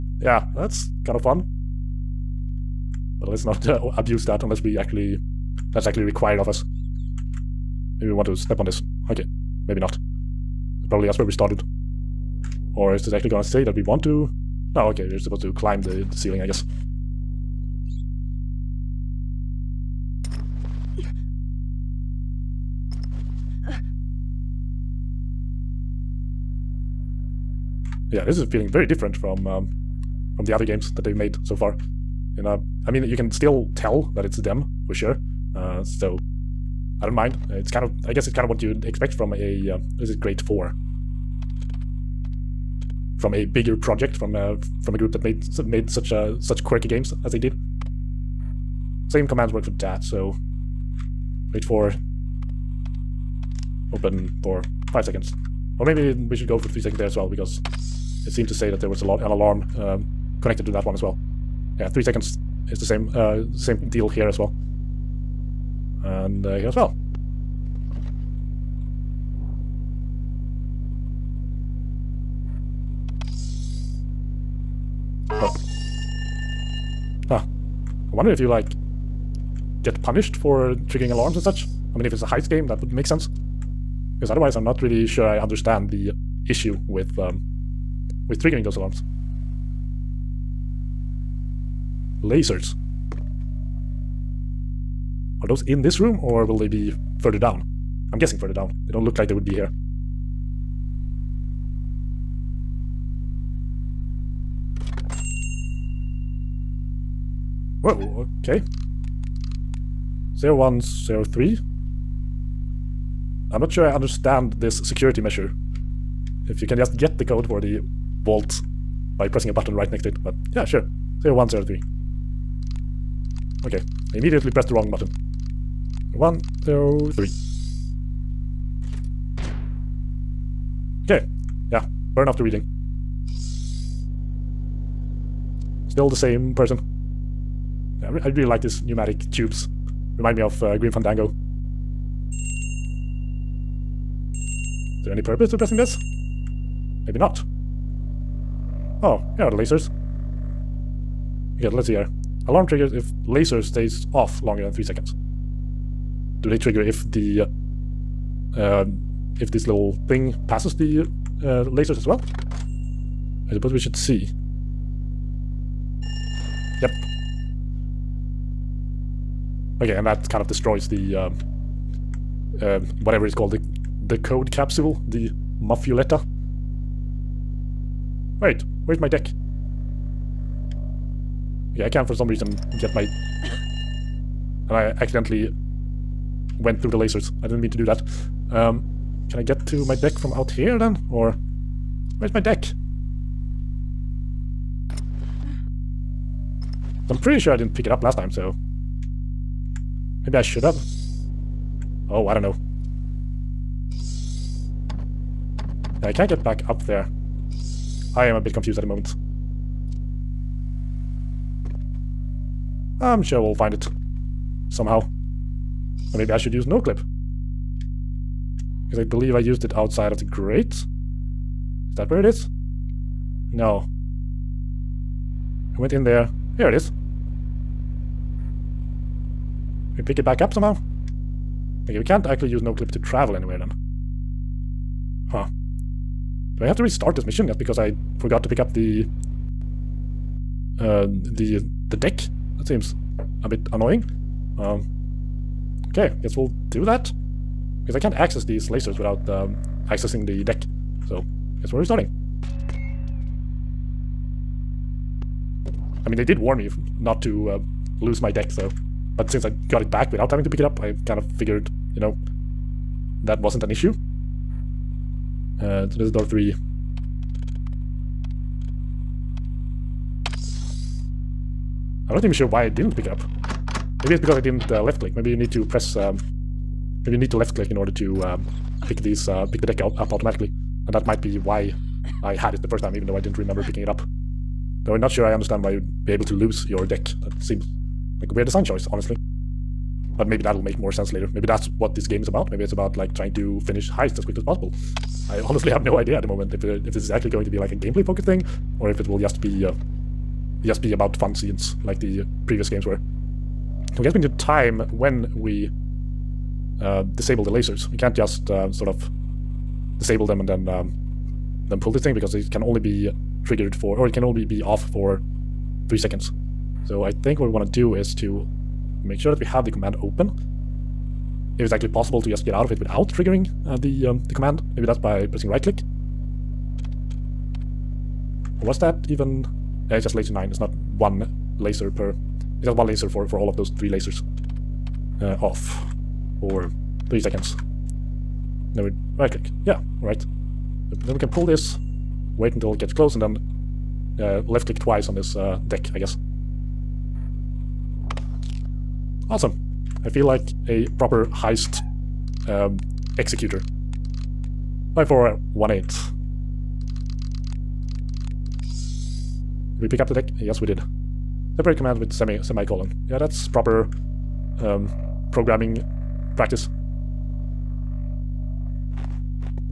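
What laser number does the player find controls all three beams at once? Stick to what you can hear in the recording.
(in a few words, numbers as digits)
9.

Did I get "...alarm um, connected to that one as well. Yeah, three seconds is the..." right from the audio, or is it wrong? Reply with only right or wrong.
right.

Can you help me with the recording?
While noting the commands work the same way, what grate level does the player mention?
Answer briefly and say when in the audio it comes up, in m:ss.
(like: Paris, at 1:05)
grade 4, at 0:40.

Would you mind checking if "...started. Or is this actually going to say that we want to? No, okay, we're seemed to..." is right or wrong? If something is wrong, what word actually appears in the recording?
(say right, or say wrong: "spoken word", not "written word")
wrong: "supposed", not "seemed".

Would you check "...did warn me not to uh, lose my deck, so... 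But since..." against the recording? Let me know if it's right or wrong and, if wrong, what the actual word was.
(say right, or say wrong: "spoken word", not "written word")
right.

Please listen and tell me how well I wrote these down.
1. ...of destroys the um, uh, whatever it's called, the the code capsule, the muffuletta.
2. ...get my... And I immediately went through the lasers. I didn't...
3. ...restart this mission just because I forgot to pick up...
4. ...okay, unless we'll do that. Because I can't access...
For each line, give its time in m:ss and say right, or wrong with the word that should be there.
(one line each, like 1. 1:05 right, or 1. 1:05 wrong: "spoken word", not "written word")
1. 2:50 right
2. 3:02 wrong: "accidentally", not "immediately"
3. 3:56 right
4. 4:05 wrong: "guess", not "unless".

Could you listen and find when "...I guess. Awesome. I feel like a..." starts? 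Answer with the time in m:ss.
5:45.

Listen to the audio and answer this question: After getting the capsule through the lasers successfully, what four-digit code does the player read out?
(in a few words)
5418.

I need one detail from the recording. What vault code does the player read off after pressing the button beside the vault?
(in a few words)
0103.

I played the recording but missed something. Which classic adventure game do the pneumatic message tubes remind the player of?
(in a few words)
Grim Fandango.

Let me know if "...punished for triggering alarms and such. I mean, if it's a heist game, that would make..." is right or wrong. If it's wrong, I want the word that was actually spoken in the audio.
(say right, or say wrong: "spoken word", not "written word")
right.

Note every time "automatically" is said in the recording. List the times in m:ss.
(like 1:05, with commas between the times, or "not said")
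4:40.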